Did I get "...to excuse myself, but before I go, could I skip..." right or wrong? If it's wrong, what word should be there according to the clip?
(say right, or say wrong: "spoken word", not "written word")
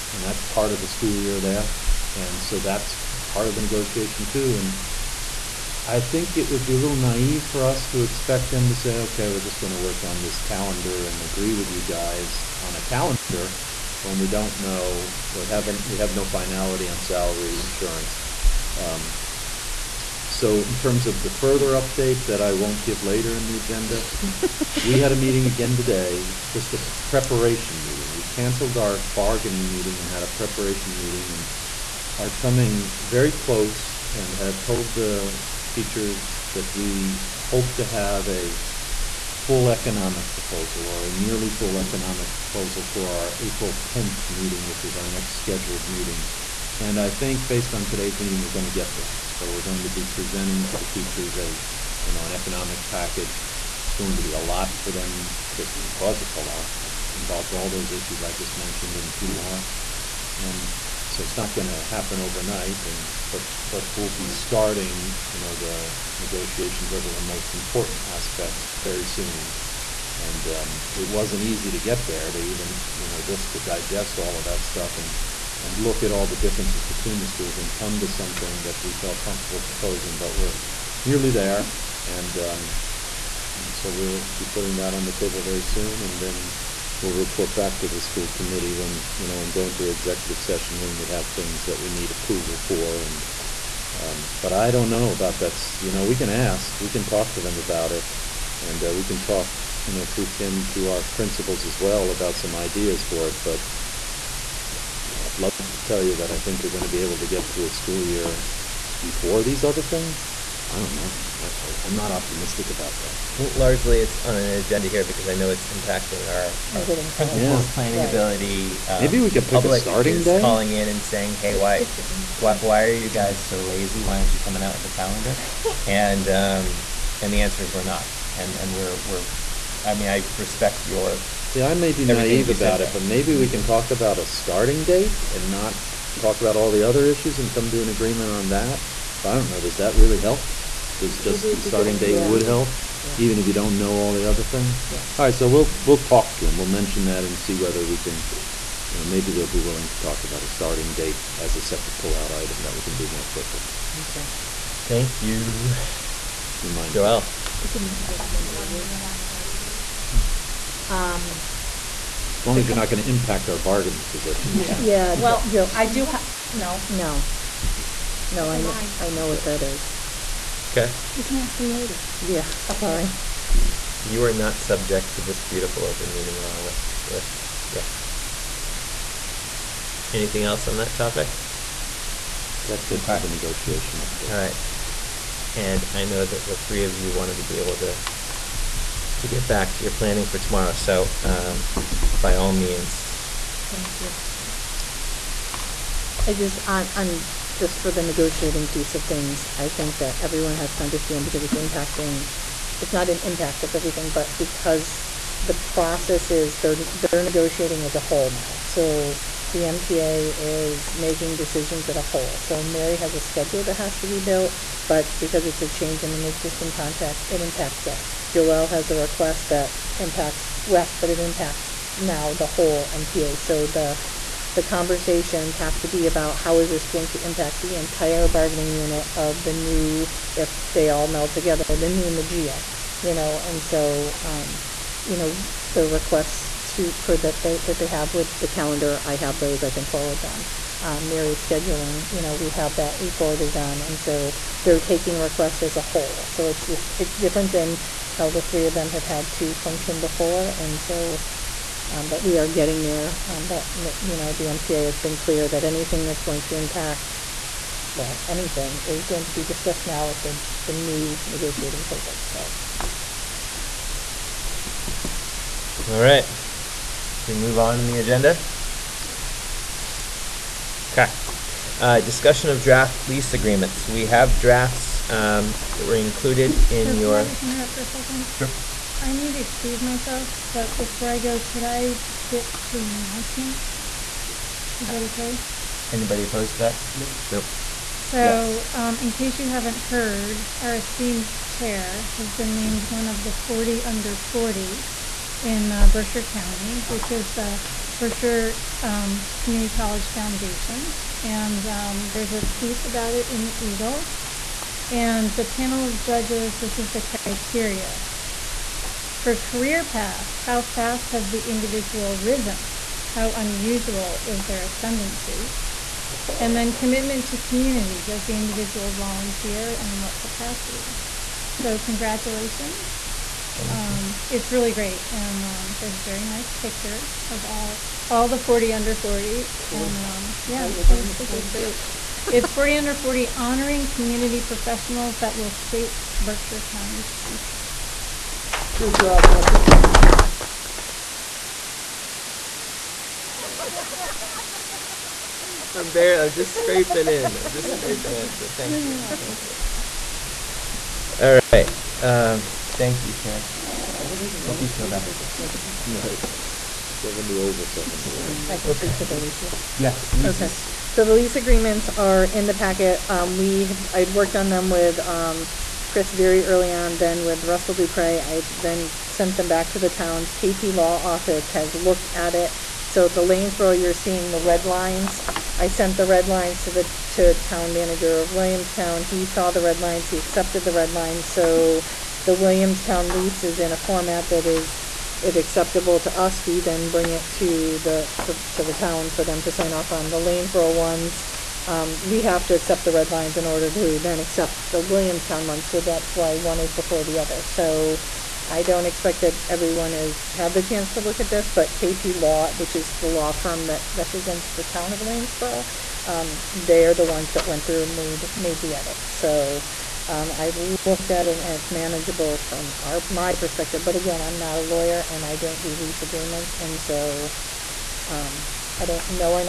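right.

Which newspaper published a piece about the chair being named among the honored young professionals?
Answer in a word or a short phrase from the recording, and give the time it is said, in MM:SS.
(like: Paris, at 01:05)
the Eagle, at 05:03.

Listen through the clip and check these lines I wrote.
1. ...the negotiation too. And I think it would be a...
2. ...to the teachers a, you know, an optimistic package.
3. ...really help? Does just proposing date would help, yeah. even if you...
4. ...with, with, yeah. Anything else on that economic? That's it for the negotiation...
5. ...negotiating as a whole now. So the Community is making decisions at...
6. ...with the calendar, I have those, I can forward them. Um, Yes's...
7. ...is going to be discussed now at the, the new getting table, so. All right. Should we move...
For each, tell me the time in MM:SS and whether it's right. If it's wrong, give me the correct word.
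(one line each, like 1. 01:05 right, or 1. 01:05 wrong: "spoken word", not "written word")
1. 00:03 right
2. 00:50 wrong: "economic", not "optimistic"
3. 02:19 wrong: "starting", not "proposing"
4. 02:56 wrong: "topic", not "economic"
5. 03:27 wrong: "MTA", not "Community"
6. 03:58 wrong: "Mary", not "Yes"
7. 04:18 wrong: "negotiating", not "getting".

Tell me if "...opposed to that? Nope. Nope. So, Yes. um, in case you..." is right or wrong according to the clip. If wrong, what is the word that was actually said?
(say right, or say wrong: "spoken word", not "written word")
right.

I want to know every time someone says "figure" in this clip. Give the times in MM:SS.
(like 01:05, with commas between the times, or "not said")
not said.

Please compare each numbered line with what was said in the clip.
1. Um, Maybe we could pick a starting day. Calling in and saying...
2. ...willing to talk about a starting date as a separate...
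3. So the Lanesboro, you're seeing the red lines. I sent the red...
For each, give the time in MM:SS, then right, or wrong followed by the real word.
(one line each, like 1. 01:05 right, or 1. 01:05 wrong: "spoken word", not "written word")
1. 01:58 right
2. 02:29 right
3. 06:12 right.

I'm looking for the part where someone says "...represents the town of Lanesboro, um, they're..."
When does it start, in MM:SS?
06:43.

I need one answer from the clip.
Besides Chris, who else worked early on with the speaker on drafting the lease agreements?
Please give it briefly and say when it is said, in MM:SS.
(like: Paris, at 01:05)
Russell Dupre, at 06:07.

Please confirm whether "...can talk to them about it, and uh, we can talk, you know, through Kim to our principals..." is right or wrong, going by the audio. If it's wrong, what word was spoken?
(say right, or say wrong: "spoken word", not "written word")
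right.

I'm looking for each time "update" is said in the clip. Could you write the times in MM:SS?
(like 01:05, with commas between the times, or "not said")
00:21, 03:03.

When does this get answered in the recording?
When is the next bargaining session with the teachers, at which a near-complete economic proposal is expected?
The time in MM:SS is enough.
00:43.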